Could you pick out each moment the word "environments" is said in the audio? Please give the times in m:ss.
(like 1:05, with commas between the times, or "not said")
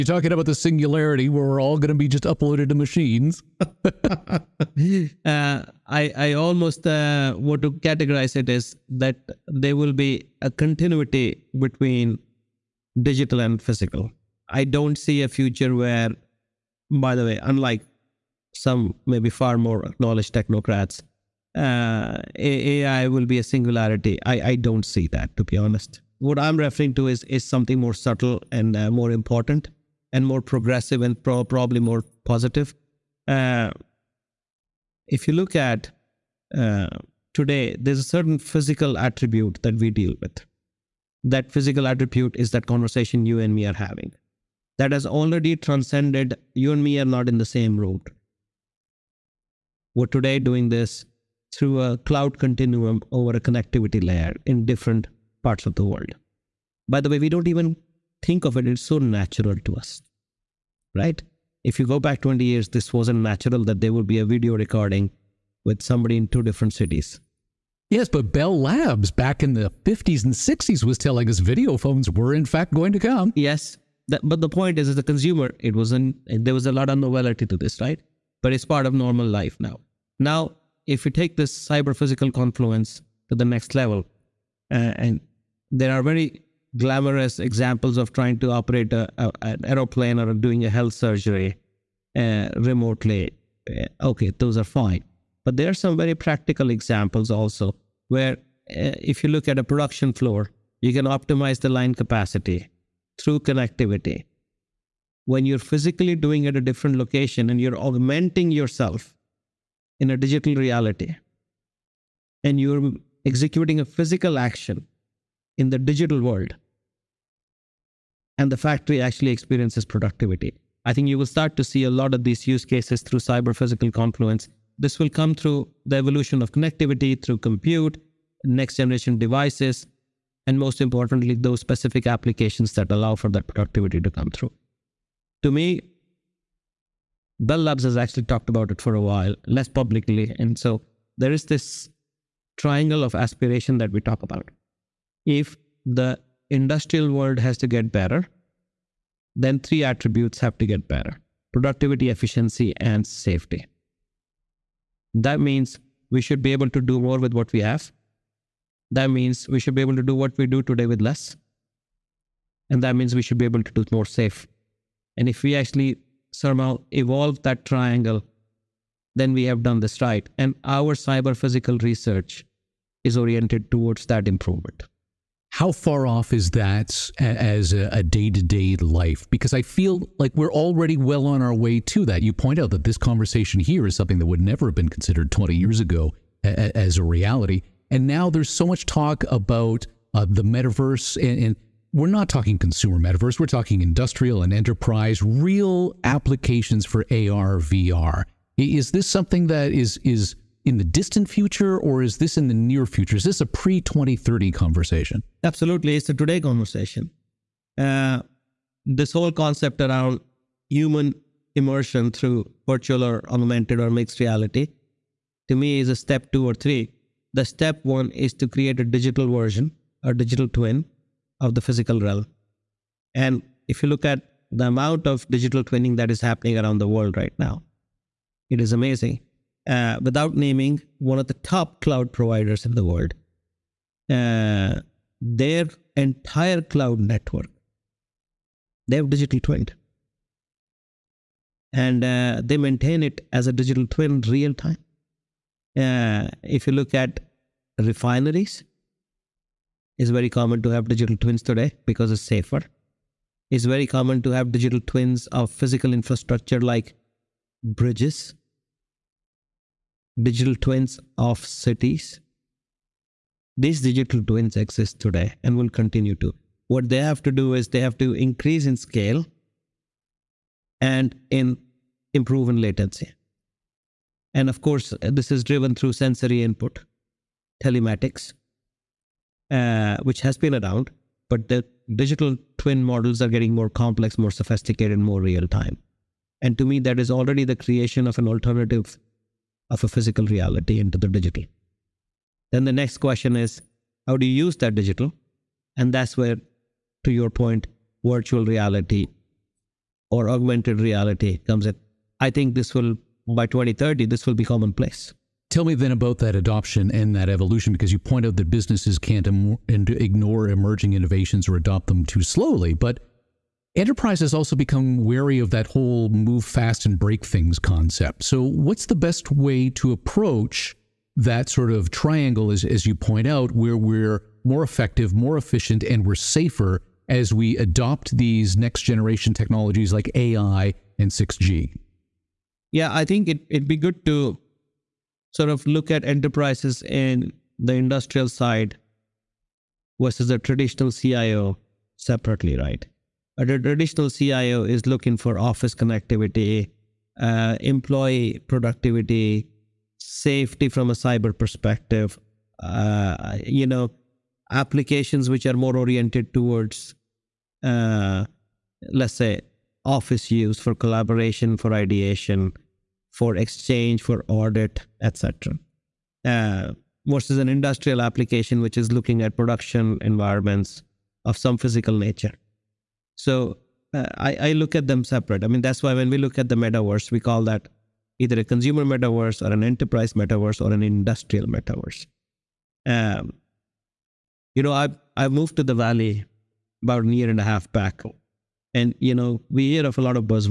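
6:10.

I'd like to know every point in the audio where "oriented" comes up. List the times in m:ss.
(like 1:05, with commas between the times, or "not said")
2:53, 5:55.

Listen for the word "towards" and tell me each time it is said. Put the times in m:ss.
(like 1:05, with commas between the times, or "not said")
2:53, 5:56.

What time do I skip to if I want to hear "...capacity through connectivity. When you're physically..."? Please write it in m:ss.
1:41.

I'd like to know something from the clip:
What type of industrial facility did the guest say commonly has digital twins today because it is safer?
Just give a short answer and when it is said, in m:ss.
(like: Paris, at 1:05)
refineries, at 4:07.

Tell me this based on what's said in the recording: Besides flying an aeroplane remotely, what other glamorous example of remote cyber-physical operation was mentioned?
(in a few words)
health surgery.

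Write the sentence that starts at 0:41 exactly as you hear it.
That physical attribute is that conversation you and me are having.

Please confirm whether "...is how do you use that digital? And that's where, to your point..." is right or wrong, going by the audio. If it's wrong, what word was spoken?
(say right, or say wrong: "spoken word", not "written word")
right.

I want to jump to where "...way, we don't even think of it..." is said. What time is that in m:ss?
0:57.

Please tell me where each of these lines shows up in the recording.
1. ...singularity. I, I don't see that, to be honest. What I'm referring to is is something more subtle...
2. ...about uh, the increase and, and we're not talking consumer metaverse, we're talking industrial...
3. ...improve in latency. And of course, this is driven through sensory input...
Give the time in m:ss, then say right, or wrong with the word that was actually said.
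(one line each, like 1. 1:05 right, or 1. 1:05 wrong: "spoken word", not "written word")
1. 0:23 right
2. 3:09 wrong: "metaverse", not "increase"
3. 4:32 right.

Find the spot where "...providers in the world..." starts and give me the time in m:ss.
3:52.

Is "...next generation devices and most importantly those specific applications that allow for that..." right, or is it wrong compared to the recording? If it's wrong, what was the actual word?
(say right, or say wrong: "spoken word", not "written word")
right.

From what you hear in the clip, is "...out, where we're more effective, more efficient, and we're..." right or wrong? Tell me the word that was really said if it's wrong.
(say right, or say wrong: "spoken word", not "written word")
right.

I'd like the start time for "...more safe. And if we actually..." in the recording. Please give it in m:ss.
2:43.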